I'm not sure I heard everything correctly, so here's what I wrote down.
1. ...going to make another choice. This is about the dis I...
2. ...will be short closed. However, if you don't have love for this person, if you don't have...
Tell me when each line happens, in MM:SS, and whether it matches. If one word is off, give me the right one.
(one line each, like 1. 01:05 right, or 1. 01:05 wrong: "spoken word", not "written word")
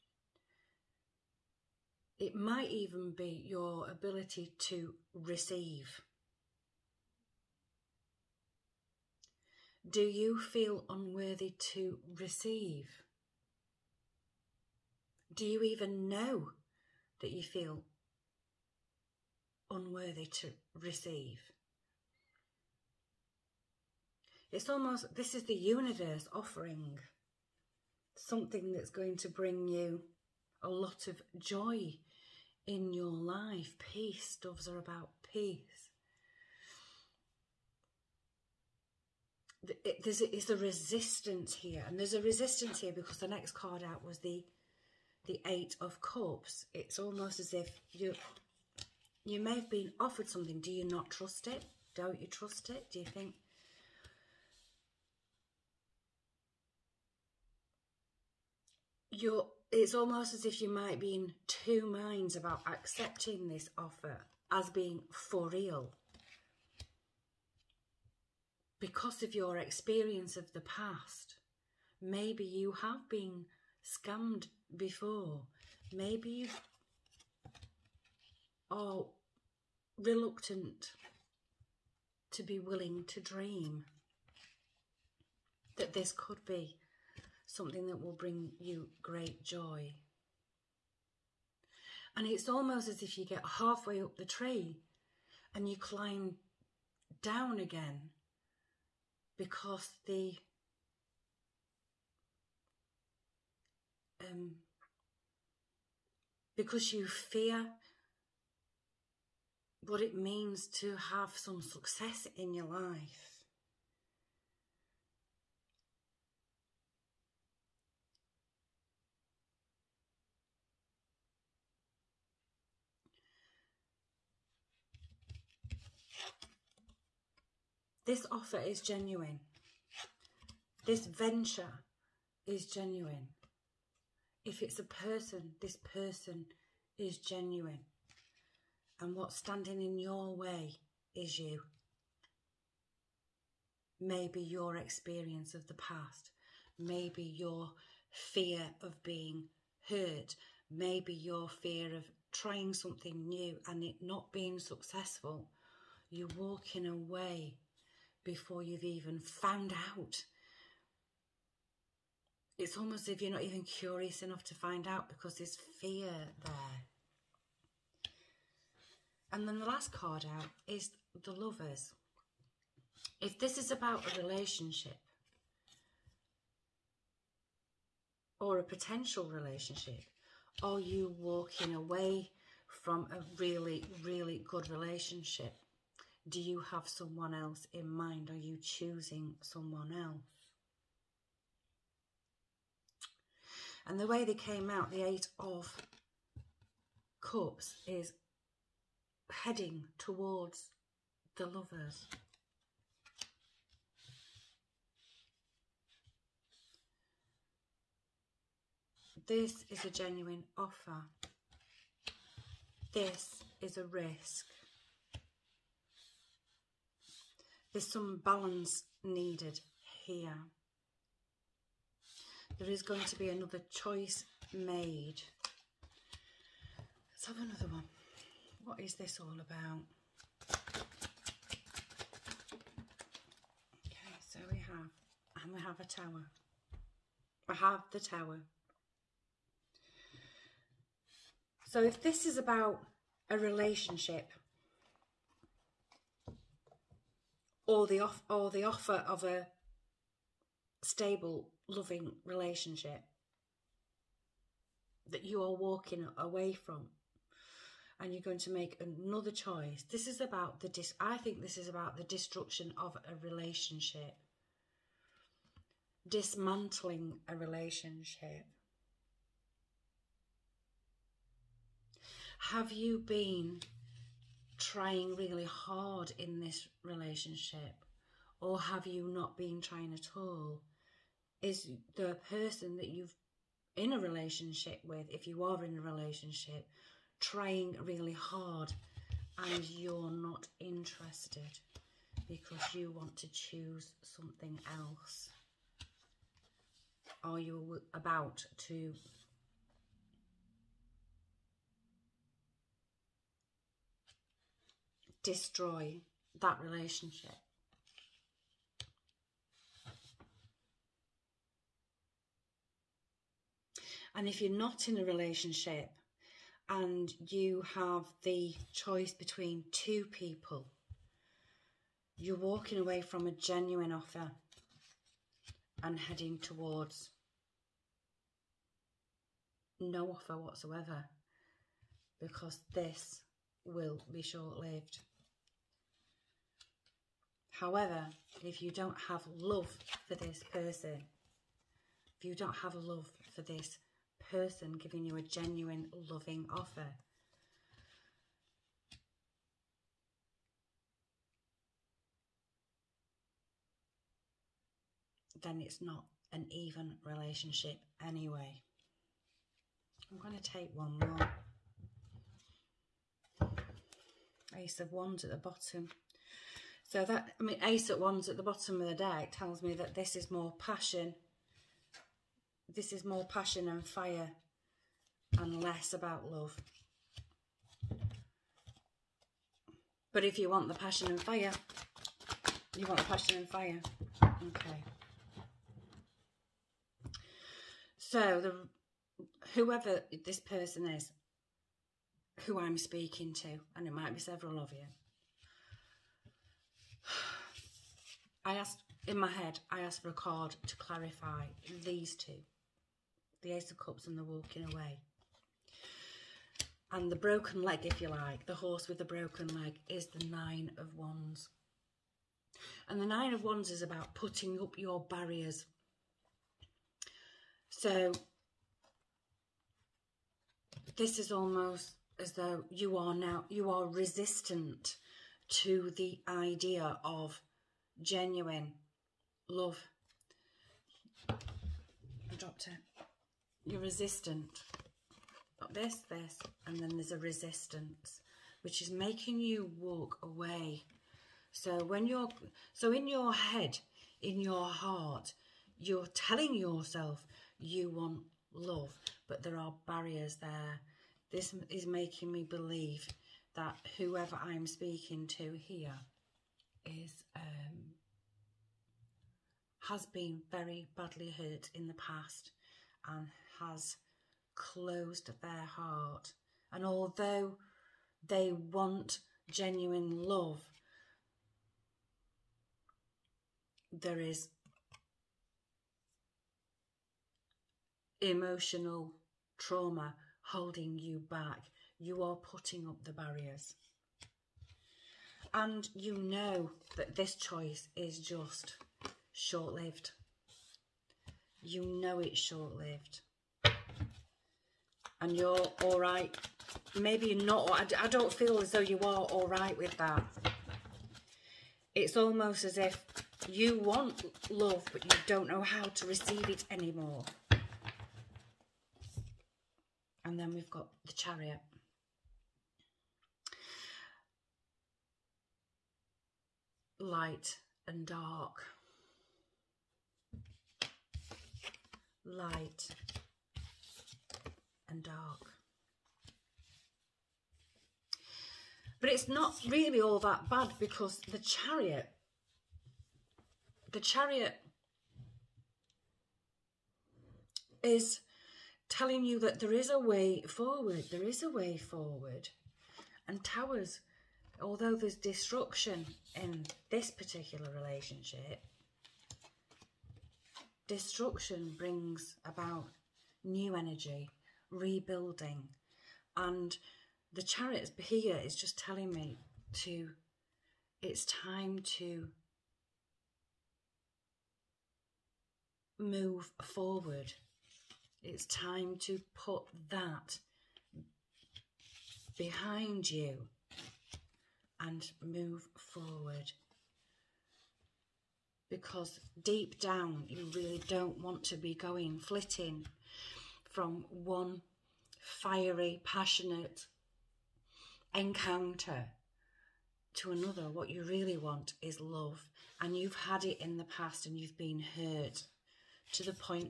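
1. 04:18 right
2. 05:33 wrong: "lived", not "closed".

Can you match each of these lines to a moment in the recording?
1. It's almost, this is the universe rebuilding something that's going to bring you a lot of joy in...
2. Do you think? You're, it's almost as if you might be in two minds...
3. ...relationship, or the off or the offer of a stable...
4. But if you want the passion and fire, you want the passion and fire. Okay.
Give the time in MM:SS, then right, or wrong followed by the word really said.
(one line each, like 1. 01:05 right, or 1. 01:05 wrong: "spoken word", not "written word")
1. 00:24 wrong: "offering", not "rebuilding"
2. 00:52 right
3. 04:03 right
4. 06:20 right.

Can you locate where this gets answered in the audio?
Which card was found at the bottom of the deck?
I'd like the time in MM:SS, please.
06:04.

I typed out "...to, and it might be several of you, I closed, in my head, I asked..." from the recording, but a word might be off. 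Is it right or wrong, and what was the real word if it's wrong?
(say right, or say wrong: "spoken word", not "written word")
wrong: "asked", not "closed".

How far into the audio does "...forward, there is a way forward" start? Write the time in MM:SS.
09:00.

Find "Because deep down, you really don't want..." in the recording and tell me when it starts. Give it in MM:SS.
09:38.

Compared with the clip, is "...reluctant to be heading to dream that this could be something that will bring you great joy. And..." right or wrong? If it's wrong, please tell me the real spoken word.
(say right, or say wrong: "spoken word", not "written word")
wrong: "willing", not "heading".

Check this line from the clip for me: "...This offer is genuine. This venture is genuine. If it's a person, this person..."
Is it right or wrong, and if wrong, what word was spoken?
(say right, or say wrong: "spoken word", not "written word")
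right.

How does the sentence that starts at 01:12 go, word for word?
Maybe you have been scammed before.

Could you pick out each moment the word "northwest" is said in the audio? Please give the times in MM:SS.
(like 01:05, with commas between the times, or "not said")
not said.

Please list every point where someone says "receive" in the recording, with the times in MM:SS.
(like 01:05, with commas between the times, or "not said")
00:05, 00:12, 00:20, 08:26.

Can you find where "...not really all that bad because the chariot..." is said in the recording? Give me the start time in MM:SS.
08:49.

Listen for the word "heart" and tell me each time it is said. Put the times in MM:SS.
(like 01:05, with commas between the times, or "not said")
07:24, 07:45.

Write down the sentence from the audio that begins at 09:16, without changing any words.
And the chariot here is just telling me to, it's time to move forward.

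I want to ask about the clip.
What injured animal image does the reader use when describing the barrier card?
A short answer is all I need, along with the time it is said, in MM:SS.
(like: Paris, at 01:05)
Horse, at 06:48.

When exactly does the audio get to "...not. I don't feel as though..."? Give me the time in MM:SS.
08:17.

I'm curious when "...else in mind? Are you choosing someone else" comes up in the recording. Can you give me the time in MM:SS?
03:07.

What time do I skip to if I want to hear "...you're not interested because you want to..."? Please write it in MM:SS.
04:49.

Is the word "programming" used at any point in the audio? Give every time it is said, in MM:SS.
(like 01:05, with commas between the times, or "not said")
not said.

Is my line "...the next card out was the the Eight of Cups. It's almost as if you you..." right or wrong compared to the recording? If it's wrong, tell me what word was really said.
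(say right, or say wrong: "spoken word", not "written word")
right.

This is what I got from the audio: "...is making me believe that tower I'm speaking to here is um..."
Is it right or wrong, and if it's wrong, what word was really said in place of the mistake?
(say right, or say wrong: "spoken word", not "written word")
wrong: "whoever", not "tower".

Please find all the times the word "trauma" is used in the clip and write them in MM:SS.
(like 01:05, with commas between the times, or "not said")
07:59.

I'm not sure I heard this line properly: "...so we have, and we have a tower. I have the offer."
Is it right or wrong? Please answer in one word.
wrong.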